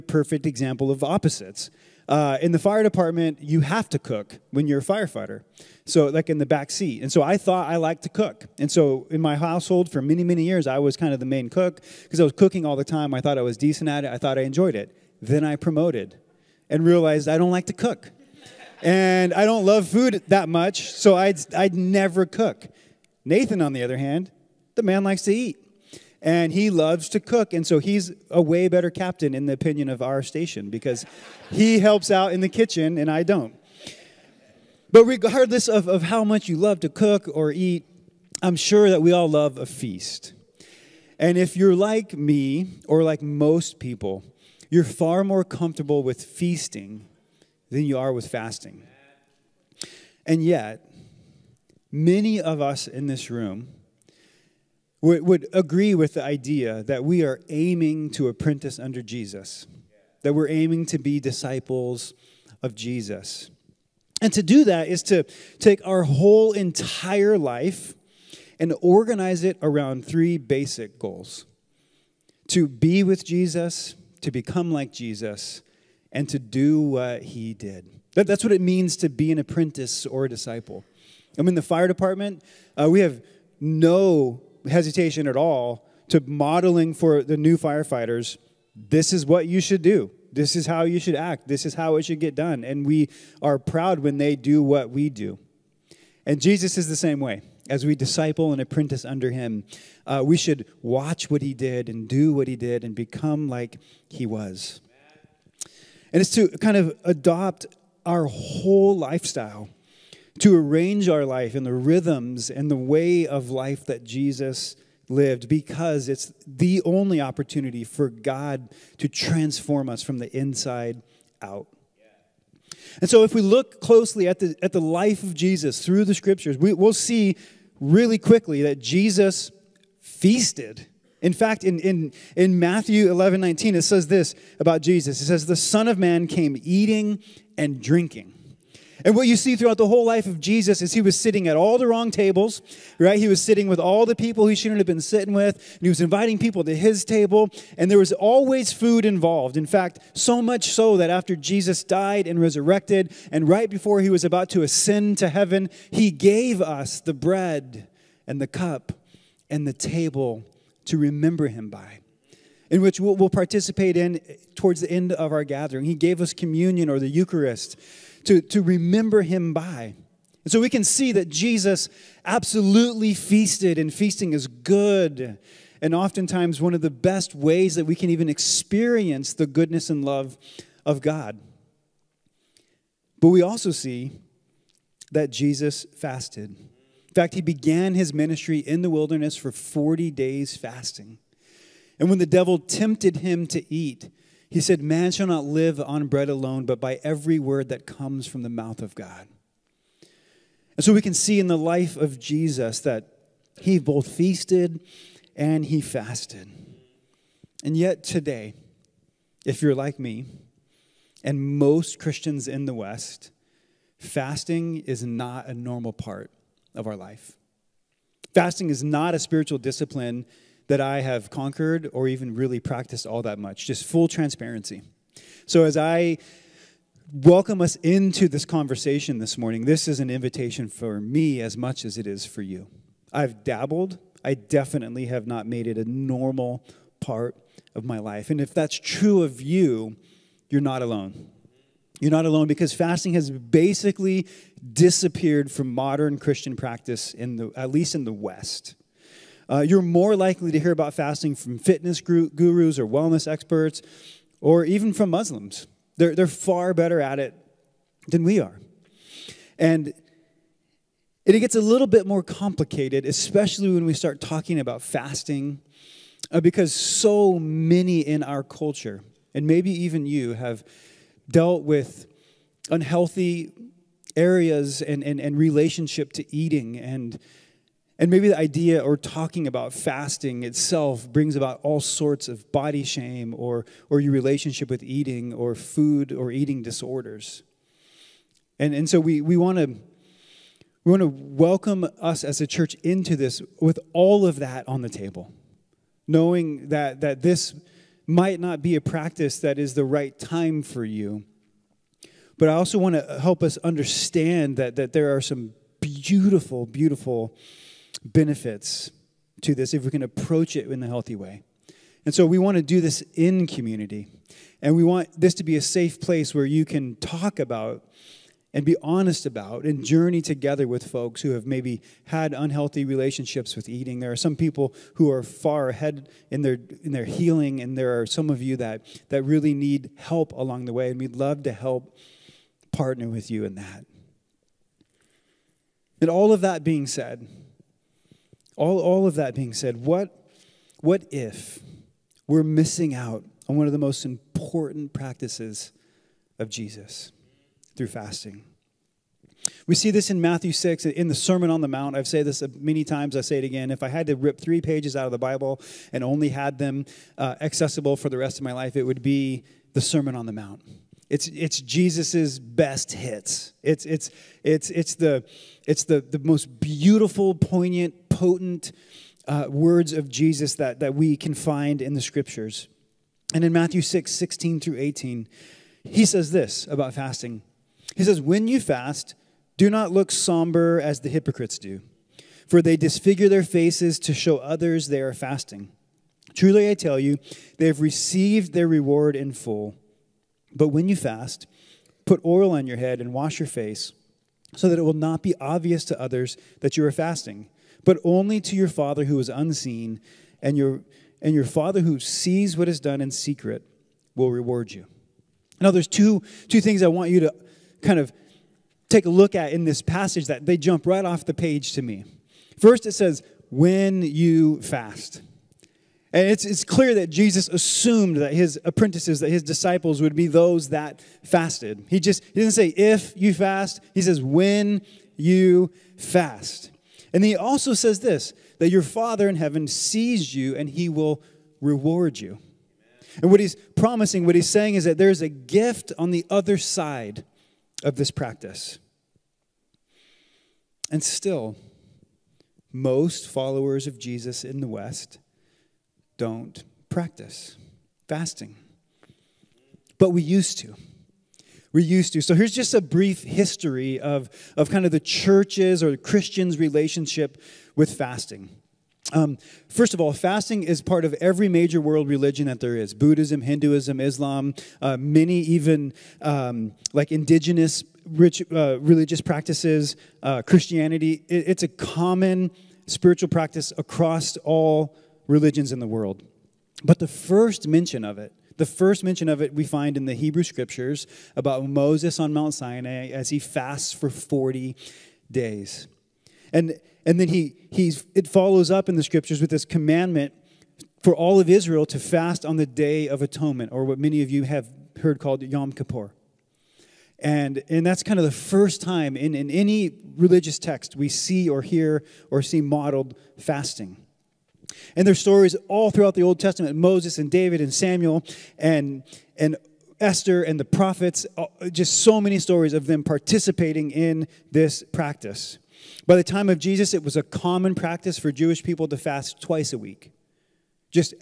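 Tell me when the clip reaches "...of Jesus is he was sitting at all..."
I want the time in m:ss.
2:20.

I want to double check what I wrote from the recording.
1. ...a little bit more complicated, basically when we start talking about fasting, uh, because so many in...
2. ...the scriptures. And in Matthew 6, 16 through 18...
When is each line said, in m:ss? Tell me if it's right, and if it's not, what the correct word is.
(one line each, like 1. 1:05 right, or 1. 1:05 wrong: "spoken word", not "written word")
1. 4:21 wrong: "especially", not "basically"
2. 6:11 right.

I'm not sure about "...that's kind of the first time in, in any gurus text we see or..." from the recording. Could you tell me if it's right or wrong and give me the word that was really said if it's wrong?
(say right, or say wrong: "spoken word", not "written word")
wrong: "religious", not "gurus".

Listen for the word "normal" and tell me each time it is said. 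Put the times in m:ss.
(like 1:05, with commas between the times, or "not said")
3:35, 3:55.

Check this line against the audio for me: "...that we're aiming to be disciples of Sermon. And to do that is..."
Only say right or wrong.
wrong.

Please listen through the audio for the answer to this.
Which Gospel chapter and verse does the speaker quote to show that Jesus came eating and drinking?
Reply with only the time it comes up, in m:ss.
2:12.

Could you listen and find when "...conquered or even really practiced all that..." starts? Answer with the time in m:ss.
3:41.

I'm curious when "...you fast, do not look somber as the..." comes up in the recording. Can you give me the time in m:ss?
6:18.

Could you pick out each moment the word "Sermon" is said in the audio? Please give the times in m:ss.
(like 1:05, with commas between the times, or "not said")
5:51, 5:59.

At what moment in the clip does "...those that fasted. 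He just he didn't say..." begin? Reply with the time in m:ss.
7:00.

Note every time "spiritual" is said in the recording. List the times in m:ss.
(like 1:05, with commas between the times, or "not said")
3:39, 7:52.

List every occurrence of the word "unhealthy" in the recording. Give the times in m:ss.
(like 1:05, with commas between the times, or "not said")
4:32, 5:22.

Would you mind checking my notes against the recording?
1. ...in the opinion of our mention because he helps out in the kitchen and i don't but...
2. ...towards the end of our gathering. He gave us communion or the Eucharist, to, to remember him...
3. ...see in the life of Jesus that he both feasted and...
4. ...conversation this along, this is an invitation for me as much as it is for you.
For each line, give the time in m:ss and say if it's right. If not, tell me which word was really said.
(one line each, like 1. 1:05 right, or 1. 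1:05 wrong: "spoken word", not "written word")
1. 0:29 wrong: "station", not "mention"
2. 2:44 right
3. 3:21 right
4. 3:48 wrong: "morning", not "along".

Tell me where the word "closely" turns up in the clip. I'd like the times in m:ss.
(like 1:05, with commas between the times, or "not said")
2:03.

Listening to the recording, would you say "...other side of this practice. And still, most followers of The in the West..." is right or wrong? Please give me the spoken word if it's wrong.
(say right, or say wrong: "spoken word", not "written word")
wrong: "Jesus", not "The".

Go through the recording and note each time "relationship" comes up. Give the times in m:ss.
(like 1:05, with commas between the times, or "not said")
4:35, 4:44, 5:22, 7:36.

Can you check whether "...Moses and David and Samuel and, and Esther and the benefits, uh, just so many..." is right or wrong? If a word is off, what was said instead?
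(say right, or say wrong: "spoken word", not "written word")
wrong: "prophets", not "benefits".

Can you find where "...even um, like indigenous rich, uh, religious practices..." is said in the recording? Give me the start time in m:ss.
7:45.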